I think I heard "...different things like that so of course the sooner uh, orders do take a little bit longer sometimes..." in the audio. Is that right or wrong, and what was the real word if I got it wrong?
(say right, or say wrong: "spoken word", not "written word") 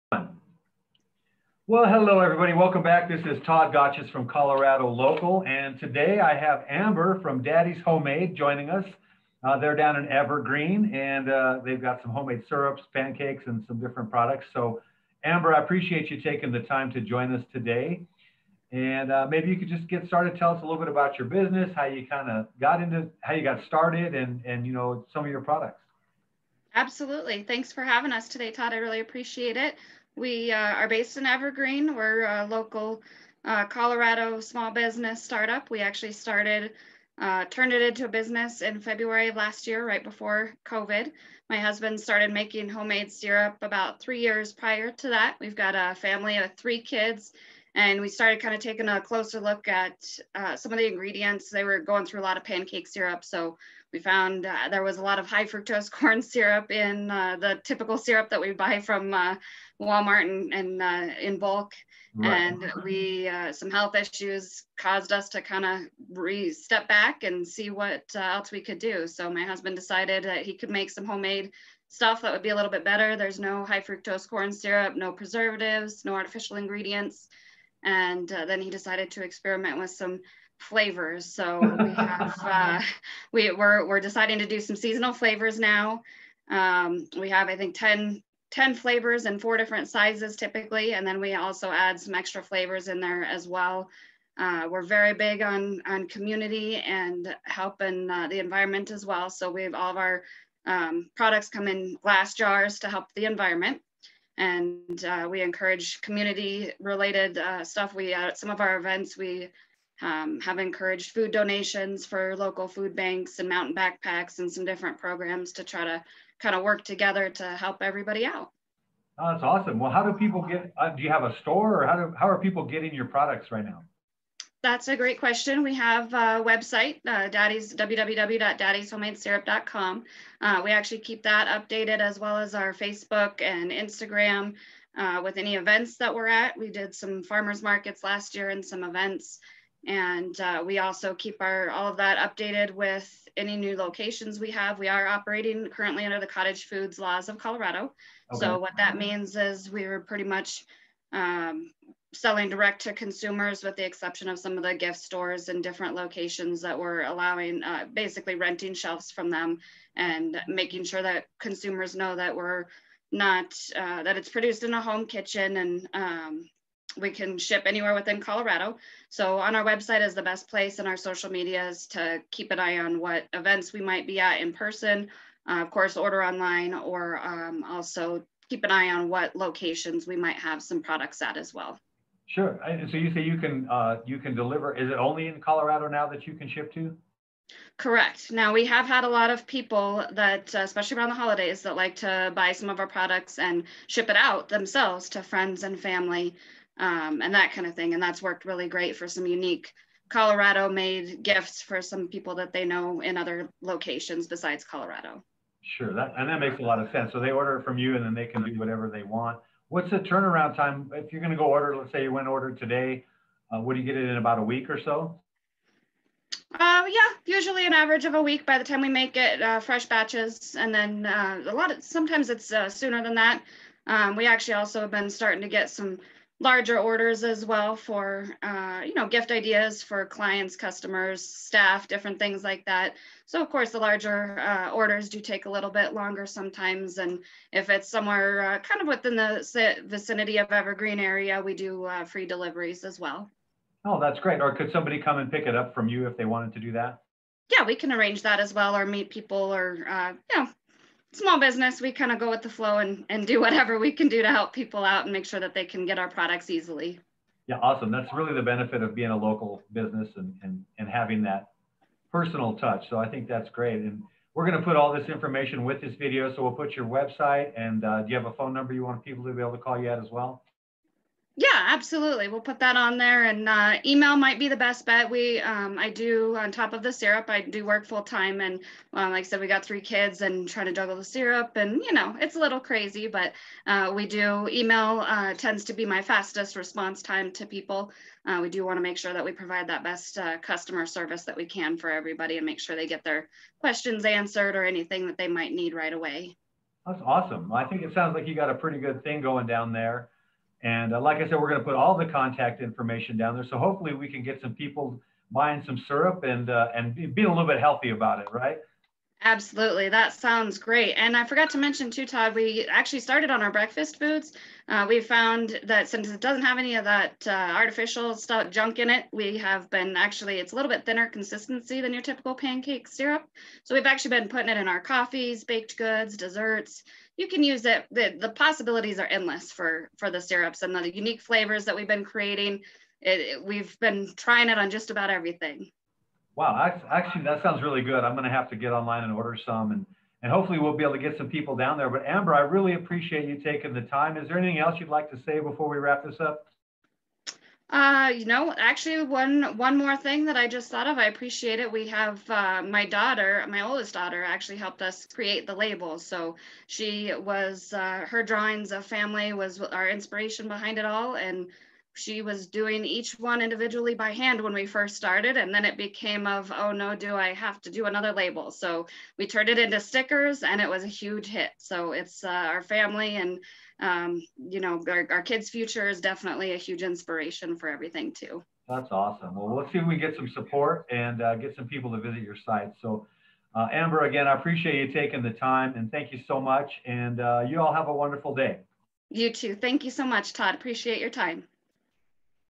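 wrong: "larger", not "sooner".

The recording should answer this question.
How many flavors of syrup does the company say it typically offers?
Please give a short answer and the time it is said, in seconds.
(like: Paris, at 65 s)
10, at 88 s.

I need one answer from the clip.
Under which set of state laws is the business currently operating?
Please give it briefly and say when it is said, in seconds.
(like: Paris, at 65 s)
Cottage foods laws, at 146 s.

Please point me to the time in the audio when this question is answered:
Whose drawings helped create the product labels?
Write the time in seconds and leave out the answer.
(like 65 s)
353 s.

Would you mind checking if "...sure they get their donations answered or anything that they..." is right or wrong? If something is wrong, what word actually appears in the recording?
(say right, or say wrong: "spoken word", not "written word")
wrong: "questions", not "donations".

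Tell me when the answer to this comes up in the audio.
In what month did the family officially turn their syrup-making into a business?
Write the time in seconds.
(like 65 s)
38 s.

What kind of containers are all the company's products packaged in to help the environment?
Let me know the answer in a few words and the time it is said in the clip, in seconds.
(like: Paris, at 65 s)
Glass jars, at 102 s.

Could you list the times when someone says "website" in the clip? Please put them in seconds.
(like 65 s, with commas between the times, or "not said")
126 s, 169 s, 266 s.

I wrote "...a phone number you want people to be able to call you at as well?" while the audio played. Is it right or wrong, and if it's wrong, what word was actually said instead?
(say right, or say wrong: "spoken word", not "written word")
right.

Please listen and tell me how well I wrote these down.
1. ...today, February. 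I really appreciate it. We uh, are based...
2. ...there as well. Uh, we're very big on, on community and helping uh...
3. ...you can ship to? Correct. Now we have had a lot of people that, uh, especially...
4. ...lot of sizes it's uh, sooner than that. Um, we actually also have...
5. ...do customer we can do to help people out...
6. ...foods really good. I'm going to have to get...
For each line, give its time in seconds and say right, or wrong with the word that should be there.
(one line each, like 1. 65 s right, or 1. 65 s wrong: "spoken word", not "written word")
1. 28 s wrong: "Todd", not "February"
2. 92 s right
3. 186 s right
4. 221 s wrong: "sometimes", not "sizes"
5. 253 s wrong: "whatever", not "customer"
6. 337 s wrong: "sounds", not "foods".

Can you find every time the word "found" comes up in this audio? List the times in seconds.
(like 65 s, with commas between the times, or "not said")
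53 s, 314 s.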